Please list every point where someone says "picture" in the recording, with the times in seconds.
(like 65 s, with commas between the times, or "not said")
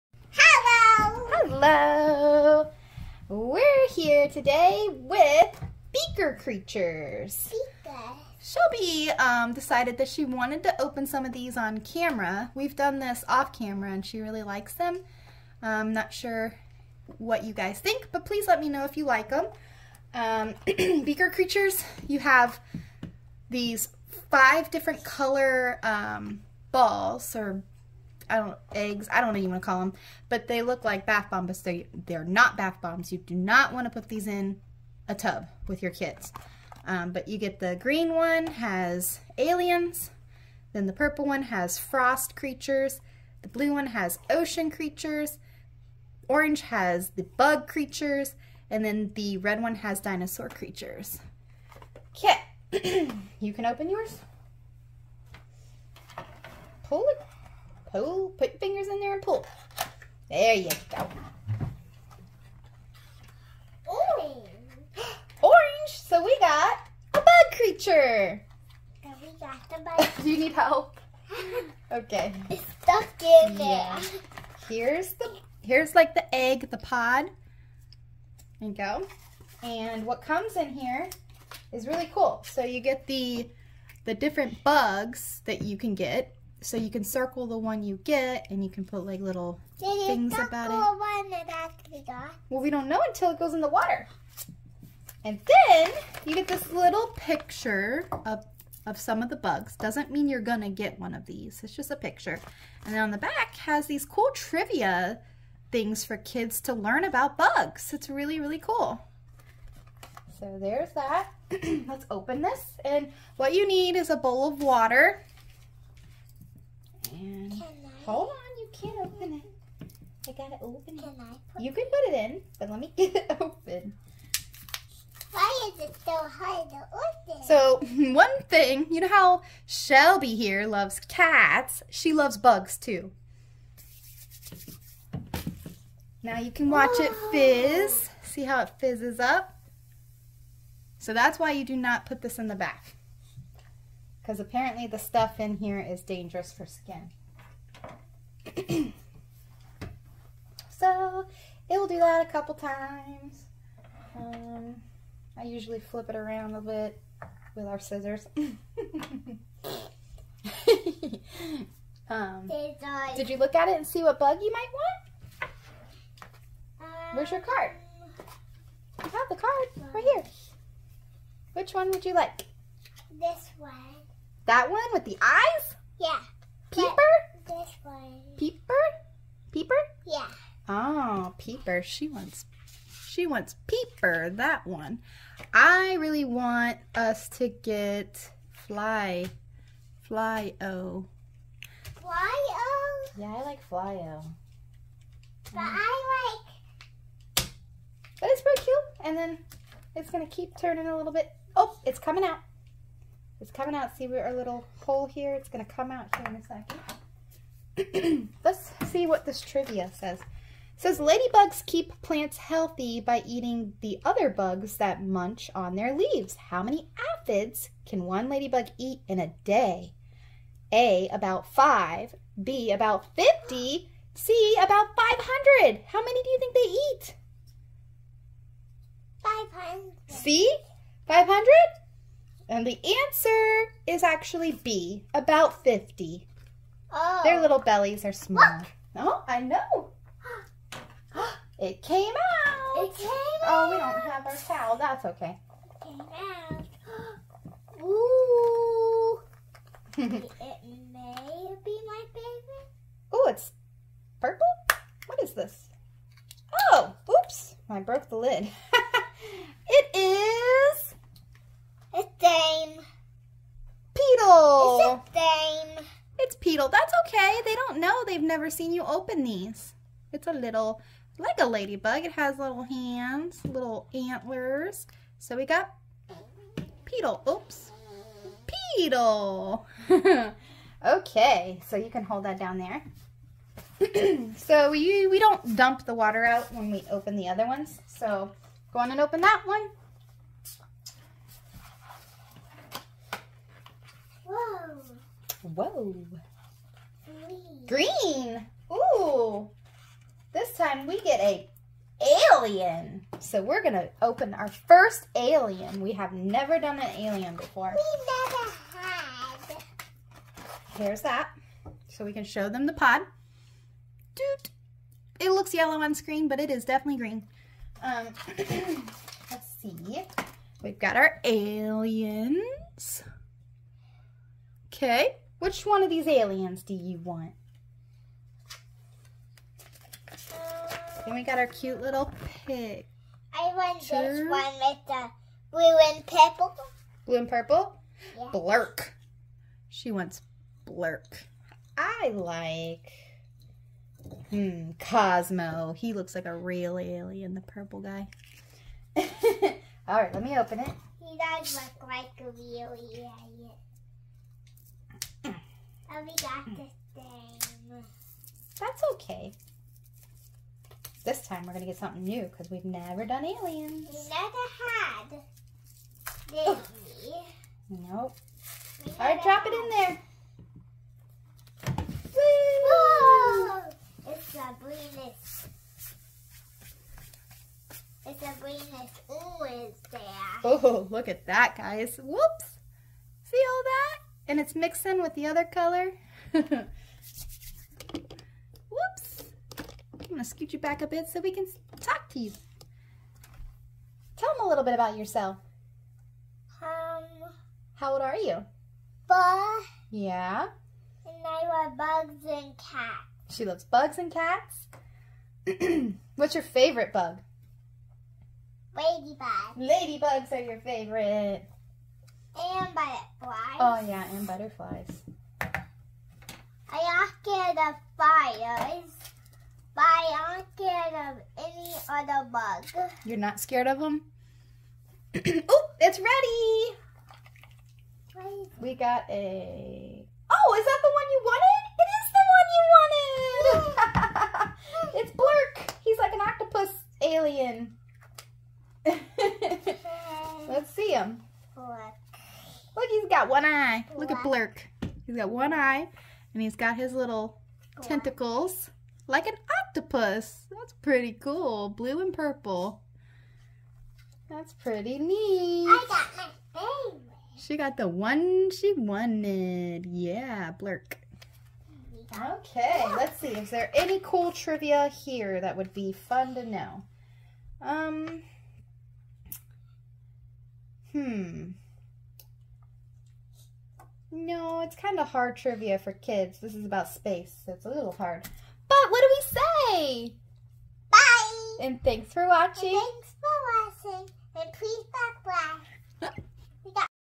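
97 s, 101 s.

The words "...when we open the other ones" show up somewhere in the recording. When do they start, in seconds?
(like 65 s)
286 s.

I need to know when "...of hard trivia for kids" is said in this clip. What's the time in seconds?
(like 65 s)
474 s.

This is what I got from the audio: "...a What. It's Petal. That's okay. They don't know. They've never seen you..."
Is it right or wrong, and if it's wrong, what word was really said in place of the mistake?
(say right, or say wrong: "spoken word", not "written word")
wrong: "Dame", not "What".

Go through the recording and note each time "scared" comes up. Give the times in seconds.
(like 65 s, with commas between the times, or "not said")
423 s.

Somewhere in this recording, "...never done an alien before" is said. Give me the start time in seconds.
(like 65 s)
306 s.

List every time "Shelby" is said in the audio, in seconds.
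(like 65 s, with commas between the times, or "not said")
8 s, 129 s.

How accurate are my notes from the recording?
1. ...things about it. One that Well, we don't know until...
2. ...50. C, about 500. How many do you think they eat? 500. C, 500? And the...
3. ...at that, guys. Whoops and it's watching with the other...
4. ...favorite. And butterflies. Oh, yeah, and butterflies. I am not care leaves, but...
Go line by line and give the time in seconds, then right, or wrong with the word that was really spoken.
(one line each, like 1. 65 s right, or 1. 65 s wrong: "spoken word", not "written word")
1. 90 s right
2. 223 s right
3. 381 s wrong: "mixing", not "watching"
4. 410 s wrong: "fires", not "leaves".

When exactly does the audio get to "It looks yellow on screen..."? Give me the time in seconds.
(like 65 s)
315 s.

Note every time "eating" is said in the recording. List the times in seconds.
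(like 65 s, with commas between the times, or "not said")
213 s.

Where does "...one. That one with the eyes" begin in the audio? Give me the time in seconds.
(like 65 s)
173 s.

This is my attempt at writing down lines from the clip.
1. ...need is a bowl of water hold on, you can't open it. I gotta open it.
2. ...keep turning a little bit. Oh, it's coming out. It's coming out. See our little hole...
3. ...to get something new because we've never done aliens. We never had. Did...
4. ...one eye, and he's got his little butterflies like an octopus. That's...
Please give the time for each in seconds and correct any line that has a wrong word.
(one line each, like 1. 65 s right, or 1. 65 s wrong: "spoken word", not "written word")
1. 113 s right
2. 200 s right
3. 361 s right
4. 445 s wrong: "tentacles", not "butterflies".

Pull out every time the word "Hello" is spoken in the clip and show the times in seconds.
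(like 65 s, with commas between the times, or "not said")
1 s.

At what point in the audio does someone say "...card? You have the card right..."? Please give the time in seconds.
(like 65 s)
167 s.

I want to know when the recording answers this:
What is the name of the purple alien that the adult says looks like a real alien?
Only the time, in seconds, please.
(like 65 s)
344 s.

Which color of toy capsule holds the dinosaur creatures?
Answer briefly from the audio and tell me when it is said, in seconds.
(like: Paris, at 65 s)
Red, at 49 s.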